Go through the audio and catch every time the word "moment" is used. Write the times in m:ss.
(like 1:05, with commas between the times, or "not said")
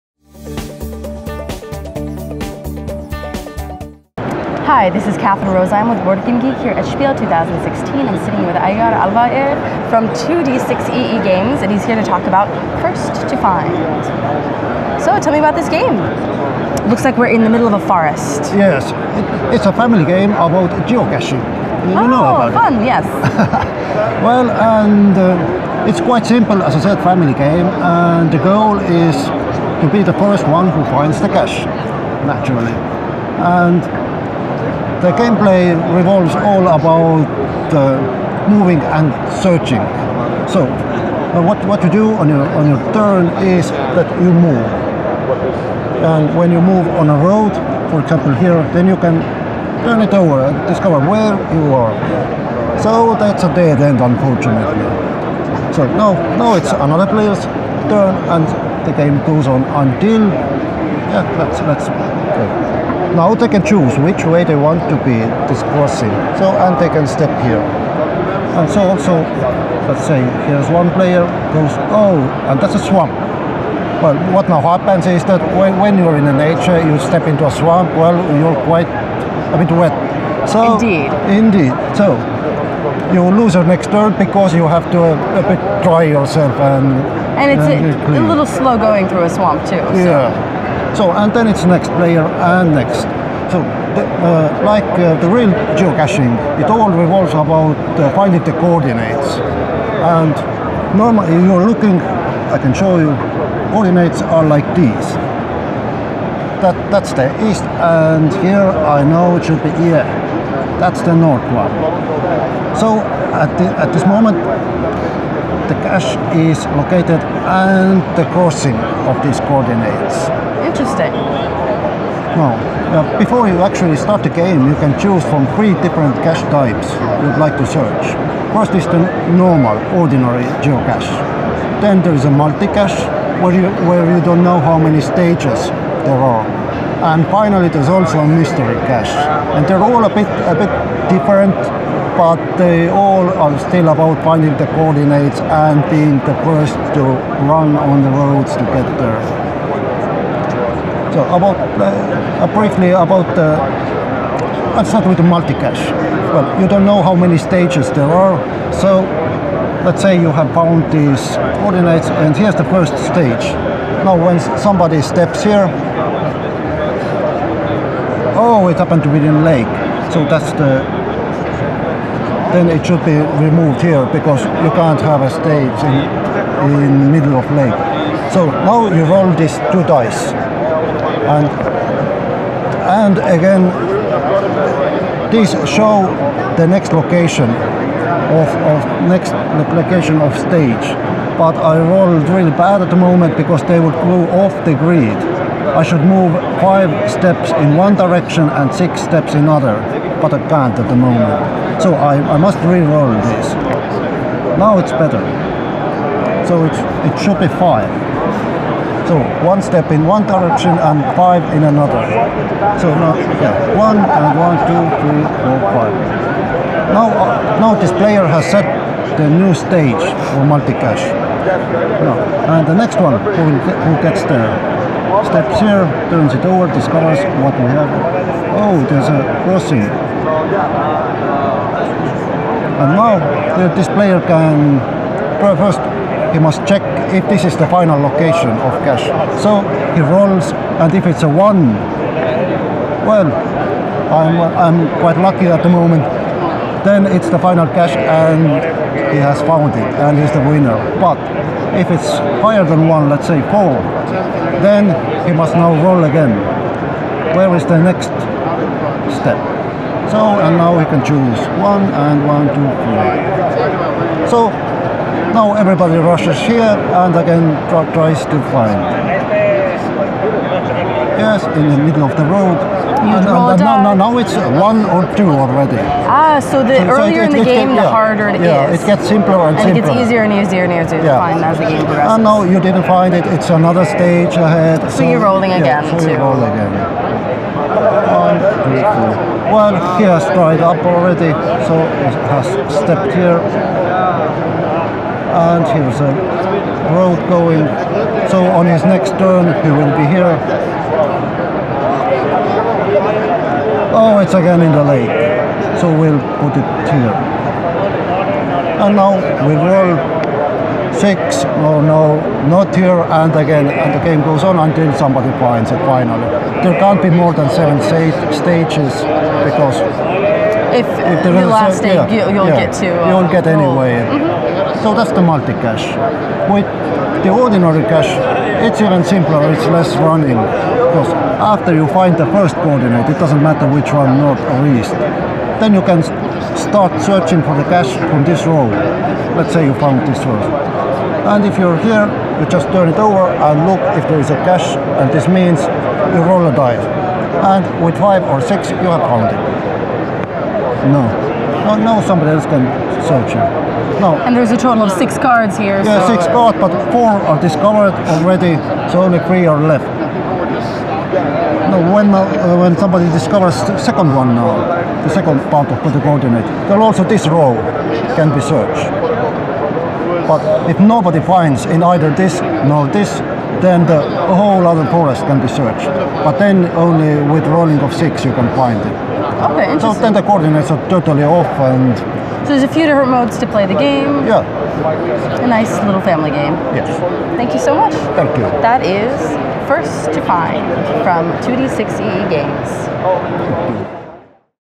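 1:54, 3:12, 3:20, 4:05.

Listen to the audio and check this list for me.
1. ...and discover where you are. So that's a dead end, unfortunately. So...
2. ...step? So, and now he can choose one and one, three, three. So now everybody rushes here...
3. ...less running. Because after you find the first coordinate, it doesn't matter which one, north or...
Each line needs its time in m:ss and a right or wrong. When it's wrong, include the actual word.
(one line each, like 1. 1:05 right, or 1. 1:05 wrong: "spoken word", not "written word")
1. 0:50 right
2. 4:19 wrong: "two", not "three"
3. 5:29 right.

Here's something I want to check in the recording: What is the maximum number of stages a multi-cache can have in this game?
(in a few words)
7.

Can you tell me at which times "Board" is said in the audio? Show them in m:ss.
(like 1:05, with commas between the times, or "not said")
0:06.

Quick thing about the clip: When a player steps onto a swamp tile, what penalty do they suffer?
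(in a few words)
lose your next turn.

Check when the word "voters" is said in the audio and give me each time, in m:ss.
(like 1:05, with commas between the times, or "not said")
not said.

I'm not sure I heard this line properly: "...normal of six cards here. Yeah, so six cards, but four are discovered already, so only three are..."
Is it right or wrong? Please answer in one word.
wrong.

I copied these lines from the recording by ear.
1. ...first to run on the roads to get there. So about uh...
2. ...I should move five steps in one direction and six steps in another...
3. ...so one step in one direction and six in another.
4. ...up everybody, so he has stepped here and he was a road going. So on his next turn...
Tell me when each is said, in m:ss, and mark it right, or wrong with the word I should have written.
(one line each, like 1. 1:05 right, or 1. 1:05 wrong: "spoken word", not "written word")
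1. 2:26 right
2. 3:15 right
3. 3:29 wrong: "five", not "six"
4. 4:50 wrong: "already", not "everybody".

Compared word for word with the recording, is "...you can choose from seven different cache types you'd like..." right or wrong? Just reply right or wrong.
wrong.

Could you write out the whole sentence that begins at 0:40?
So, uh, what, what you do on your, on your turn is that you move.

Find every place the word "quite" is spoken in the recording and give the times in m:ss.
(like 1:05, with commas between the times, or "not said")
0:25, 1:18, 4:04.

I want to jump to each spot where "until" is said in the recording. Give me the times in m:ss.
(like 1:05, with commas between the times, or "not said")
0:59, 5:14.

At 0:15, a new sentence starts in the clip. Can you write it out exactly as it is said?
So, tell me about this game.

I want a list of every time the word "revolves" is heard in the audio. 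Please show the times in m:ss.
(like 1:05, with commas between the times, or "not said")
0:35, 1:36.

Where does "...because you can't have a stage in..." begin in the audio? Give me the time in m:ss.
2:54.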